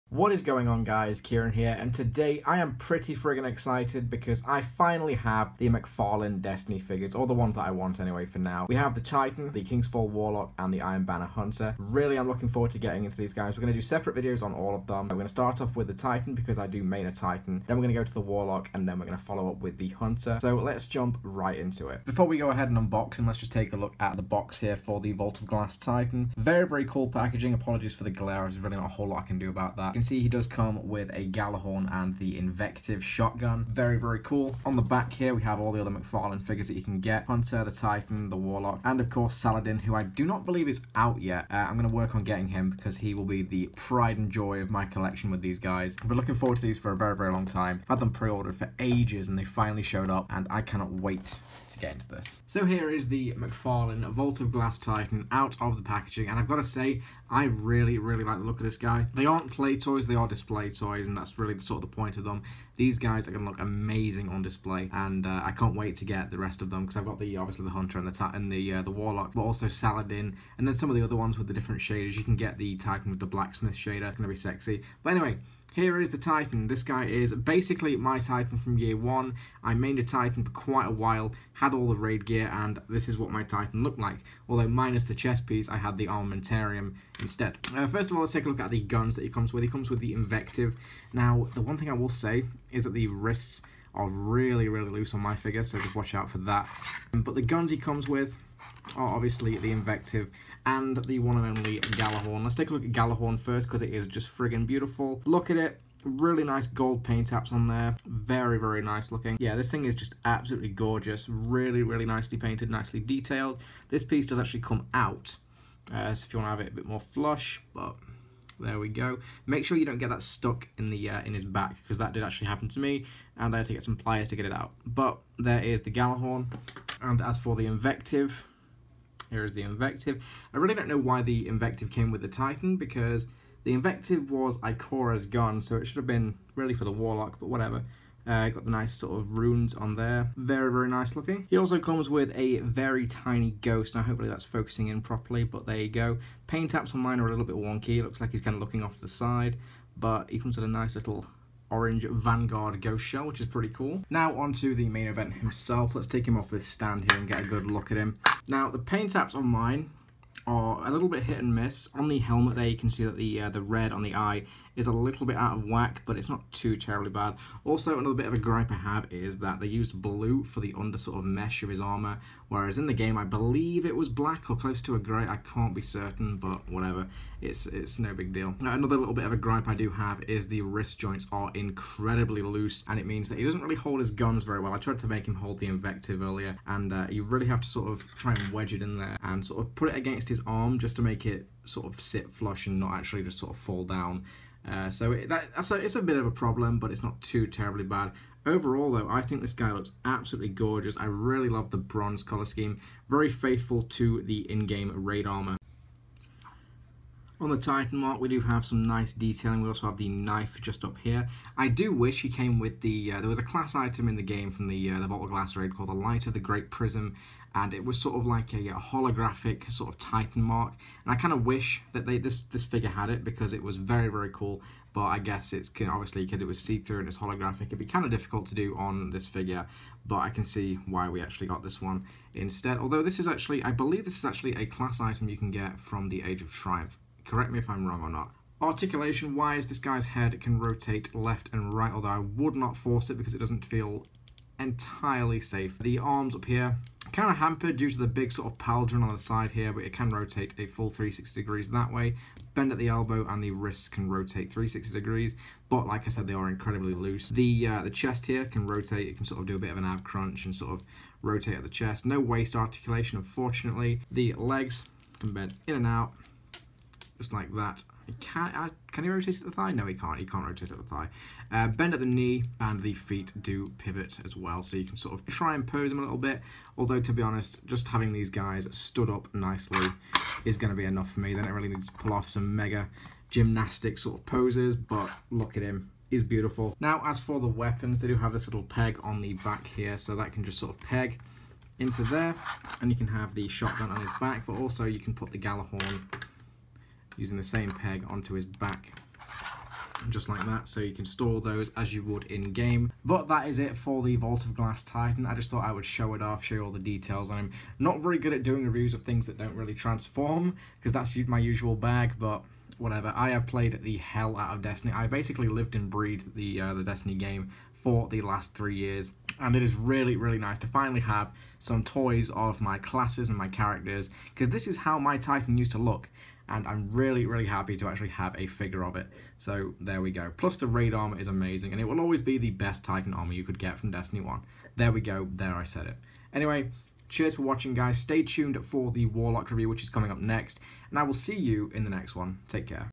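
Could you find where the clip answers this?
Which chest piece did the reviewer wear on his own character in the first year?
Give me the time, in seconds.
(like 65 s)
86 s.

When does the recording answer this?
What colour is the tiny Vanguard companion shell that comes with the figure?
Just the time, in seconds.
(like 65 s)
151 s.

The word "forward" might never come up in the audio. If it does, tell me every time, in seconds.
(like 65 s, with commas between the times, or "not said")
12 s, 46 s.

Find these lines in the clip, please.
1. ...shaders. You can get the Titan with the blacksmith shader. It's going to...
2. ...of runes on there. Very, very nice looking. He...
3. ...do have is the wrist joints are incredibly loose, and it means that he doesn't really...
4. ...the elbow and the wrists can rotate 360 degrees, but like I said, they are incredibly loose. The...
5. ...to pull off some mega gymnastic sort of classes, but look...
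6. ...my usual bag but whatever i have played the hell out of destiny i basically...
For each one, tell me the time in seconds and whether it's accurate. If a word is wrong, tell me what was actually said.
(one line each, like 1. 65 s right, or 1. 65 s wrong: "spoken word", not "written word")
1. 71 s right
2. 139 s right
3. 179 s right
4. 252 s right
5. 281 s wrong: "poses", not "classes"
6. 311 s right.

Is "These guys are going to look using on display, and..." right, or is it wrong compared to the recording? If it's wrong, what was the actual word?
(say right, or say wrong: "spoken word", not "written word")
wrong: "amazing", not "using".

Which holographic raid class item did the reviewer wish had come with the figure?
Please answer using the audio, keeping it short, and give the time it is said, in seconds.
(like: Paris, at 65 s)
Light of the Great Prism, at 215 s.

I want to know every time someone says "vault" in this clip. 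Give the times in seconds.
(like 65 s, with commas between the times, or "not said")
25 s, 54 s, 215 s, 304 s.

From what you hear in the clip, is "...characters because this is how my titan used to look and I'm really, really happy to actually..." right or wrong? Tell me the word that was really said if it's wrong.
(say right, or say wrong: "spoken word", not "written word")
right.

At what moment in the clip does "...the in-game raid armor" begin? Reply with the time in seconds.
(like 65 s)
204 s.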